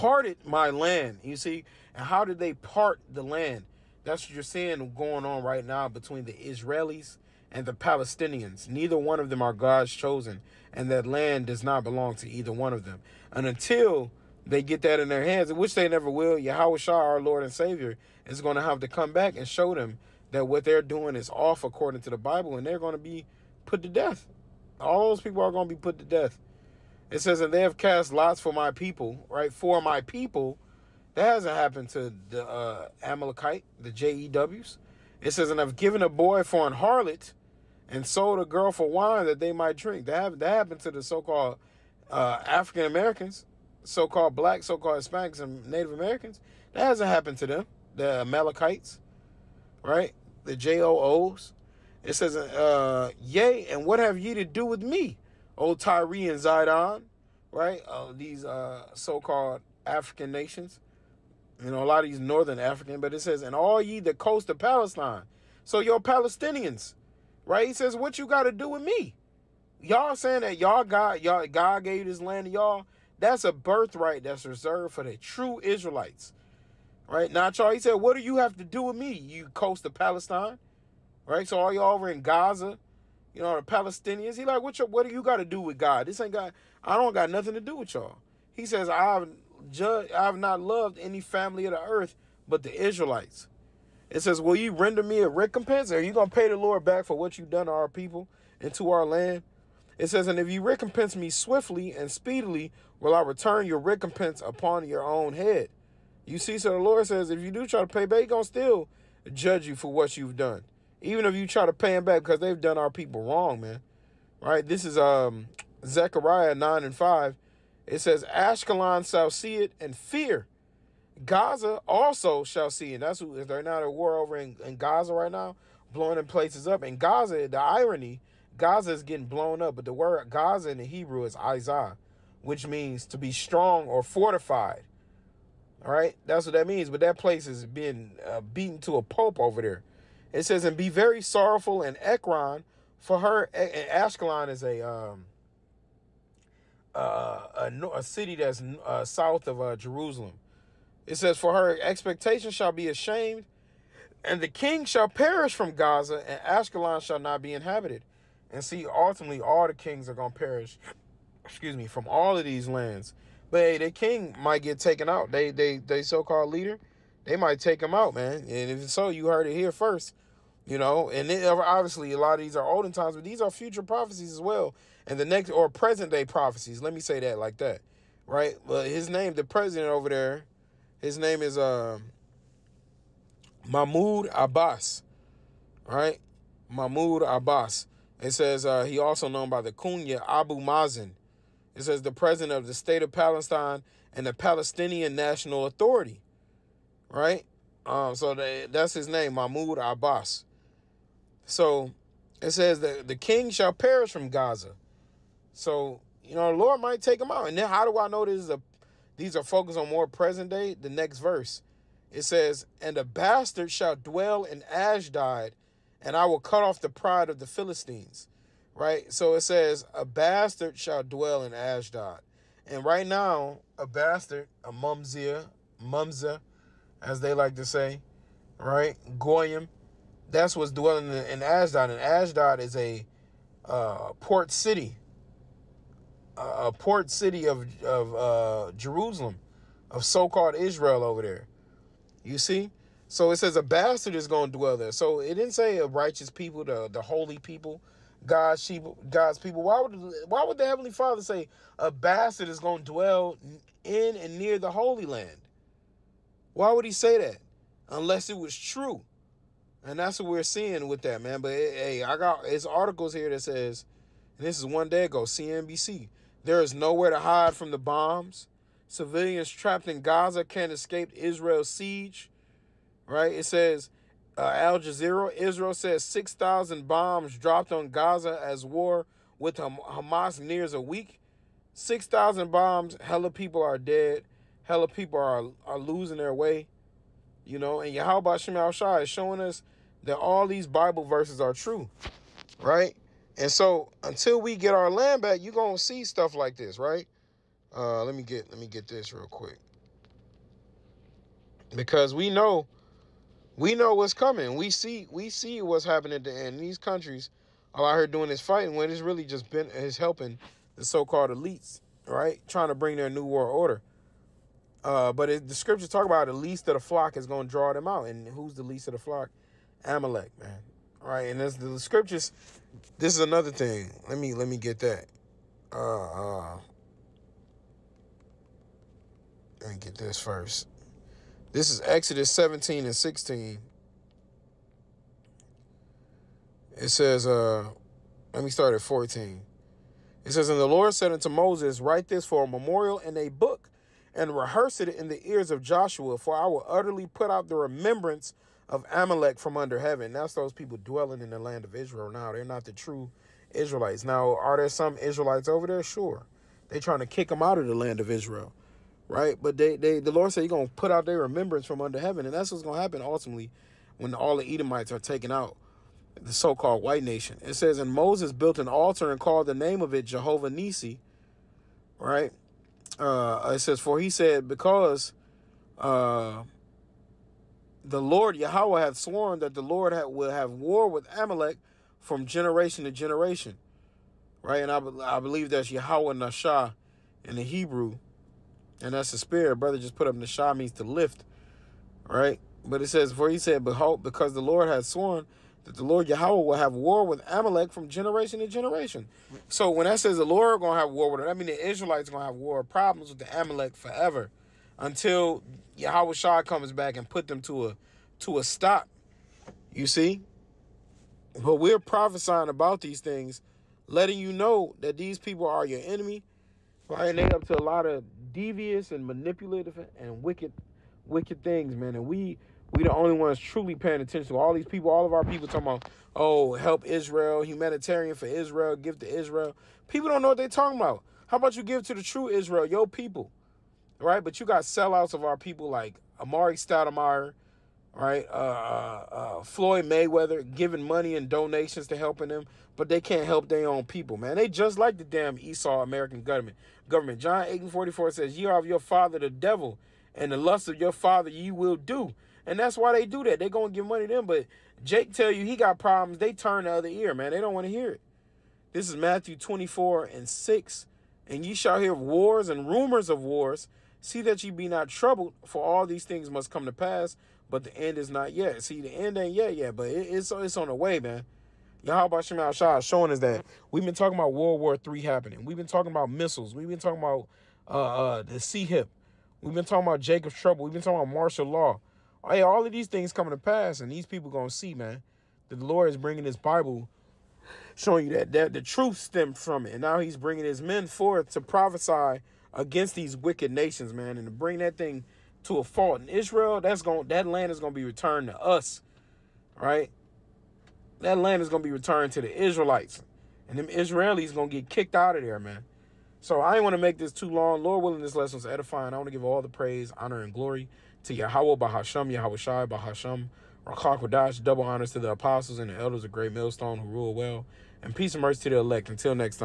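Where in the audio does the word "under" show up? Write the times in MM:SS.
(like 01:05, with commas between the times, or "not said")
05:49, 06:01.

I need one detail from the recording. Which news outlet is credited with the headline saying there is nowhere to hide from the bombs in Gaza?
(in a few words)
CNBC.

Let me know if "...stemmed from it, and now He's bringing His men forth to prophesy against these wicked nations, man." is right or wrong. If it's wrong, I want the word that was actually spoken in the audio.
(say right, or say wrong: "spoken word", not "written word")
right.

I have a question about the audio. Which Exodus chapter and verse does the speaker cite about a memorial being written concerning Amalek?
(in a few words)
Exodus 17:16.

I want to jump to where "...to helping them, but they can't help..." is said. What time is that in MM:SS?
07:21.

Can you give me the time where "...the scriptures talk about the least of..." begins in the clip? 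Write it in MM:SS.
05:15.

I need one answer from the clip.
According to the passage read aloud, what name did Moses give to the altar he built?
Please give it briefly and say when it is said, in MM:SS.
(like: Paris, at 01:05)
Jehovah Nisi, at 06:10.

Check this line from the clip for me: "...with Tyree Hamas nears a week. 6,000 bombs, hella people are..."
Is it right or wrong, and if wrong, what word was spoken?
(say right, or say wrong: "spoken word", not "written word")
wrong: "Ham", not "Tyree".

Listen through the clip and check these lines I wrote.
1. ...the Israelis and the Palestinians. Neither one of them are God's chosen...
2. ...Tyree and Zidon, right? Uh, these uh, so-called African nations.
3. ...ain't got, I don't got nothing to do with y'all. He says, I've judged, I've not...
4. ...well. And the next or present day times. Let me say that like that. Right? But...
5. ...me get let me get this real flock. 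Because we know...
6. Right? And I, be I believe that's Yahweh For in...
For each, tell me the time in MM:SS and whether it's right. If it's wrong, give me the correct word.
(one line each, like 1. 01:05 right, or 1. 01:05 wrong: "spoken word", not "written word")
1. 00:06 right
2. 00:55 right
3. 01:26 right
4. 02:54 wrong: "prophecies", not "times"
5. 04:58 wrong: "quick", not "flock"
6. 06:24 wrong: "Nashah", not "For".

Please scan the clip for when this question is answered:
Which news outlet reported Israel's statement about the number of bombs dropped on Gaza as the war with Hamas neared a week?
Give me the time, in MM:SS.
04:34.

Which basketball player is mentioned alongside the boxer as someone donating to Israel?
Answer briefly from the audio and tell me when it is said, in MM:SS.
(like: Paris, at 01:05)
Amar'e Stoudemire, at 07:16.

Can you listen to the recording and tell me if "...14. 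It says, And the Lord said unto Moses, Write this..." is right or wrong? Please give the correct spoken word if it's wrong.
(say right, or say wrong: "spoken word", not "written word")
right.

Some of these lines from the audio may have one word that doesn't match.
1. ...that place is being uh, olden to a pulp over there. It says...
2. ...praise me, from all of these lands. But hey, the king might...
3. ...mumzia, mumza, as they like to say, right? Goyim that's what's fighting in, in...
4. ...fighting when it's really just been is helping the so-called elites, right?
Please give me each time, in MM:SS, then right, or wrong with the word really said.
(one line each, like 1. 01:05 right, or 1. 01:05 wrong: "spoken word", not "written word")
1. 02:17 wrong: "beaten", not "olden"
2. 02:41 wrong: "excuse", not "praise"
3. 03:44 wrong: "dwelling", not "fighting"
4. 05:08 right.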